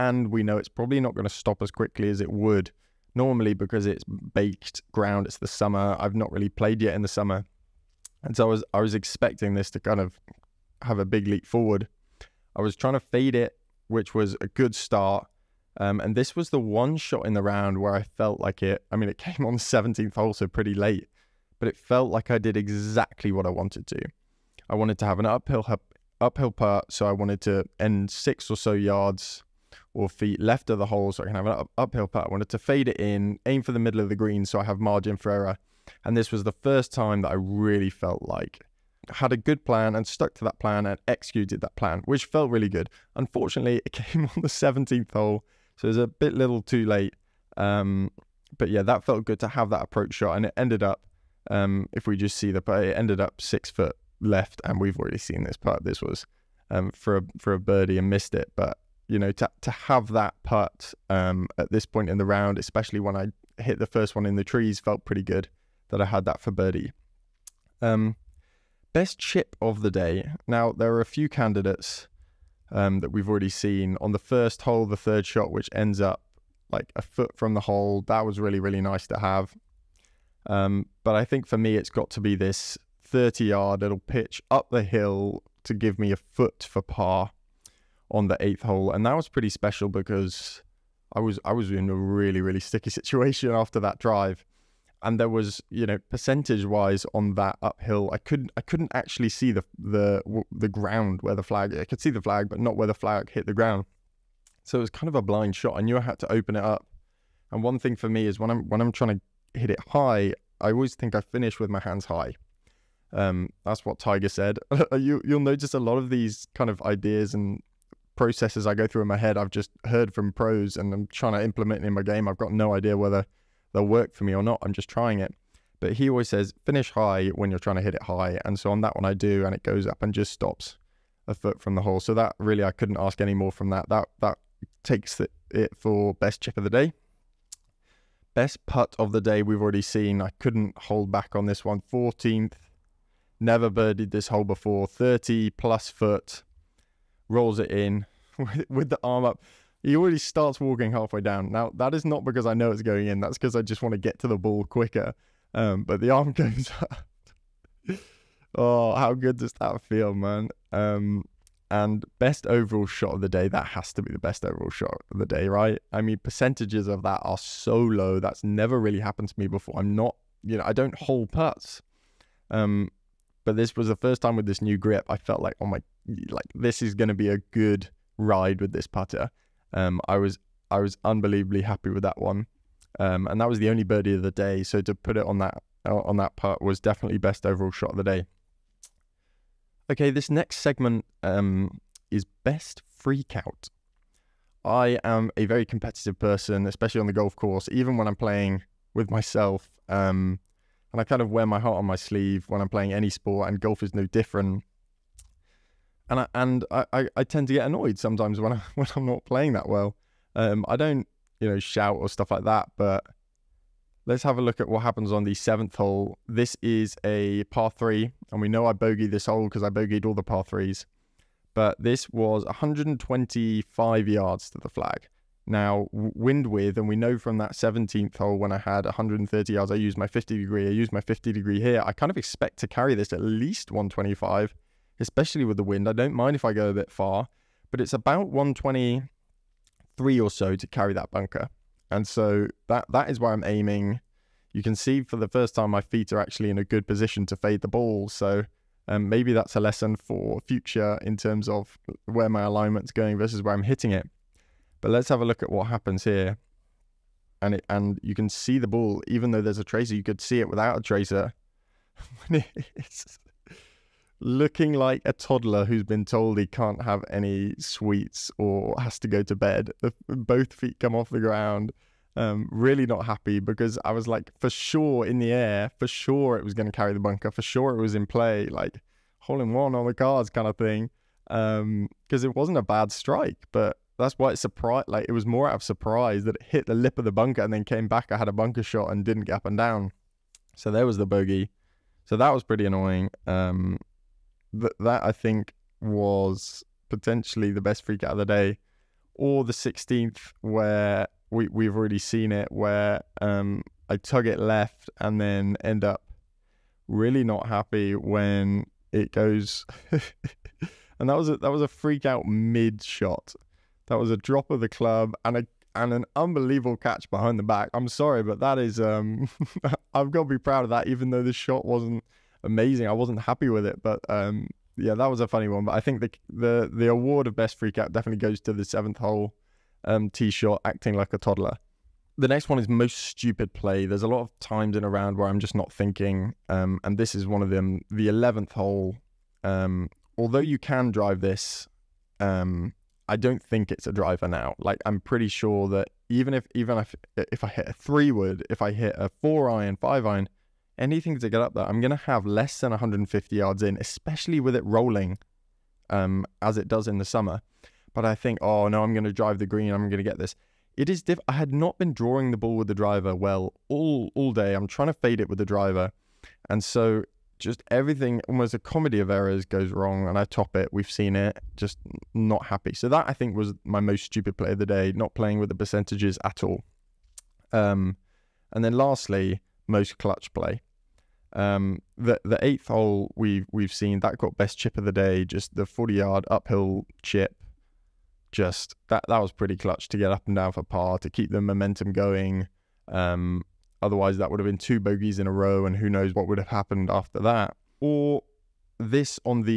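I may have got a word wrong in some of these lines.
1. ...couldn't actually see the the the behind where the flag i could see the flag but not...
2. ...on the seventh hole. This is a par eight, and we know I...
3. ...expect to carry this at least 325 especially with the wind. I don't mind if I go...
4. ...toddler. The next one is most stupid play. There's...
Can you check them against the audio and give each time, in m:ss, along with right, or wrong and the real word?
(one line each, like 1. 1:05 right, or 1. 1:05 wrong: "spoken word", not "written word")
1. 1:38 wrong: "ground", not "behind"
2. 3:35 wrong: "three", not "eight"
3. 3:52 wrong: "125", not "325"
4. 5:31 right.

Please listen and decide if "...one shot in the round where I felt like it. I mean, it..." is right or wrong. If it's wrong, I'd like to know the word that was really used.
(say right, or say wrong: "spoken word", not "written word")
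right.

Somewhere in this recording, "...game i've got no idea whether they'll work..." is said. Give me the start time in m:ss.
2:02.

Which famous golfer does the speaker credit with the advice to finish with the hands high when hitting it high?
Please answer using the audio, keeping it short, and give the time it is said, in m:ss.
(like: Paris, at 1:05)
Tiger, at 1:53.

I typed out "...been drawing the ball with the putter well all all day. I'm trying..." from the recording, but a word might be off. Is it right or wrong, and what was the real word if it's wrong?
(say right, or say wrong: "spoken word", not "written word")
wrong: "driver", not "putter".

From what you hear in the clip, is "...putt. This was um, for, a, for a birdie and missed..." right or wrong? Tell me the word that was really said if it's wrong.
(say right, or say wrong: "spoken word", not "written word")
right.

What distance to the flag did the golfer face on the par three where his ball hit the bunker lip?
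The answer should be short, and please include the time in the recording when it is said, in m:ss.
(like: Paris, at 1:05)
125 yards, at 3:42.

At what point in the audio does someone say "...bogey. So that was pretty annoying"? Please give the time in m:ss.
4:51.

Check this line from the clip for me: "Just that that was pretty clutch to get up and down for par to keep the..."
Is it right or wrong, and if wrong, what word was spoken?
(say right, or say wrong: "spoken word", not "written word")
right.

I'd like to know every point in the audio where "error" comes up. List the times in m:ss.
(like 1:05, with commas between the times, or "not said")
0:35, 6:09.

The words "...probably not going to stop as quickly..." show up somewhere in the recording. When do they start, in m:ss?
0:00.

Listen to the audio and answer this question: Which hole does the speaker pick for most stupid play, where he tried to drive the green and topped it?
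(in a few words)
eleventh.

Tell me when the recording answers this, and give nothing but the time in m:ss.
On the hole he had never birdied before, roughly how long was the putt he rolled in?
2:24.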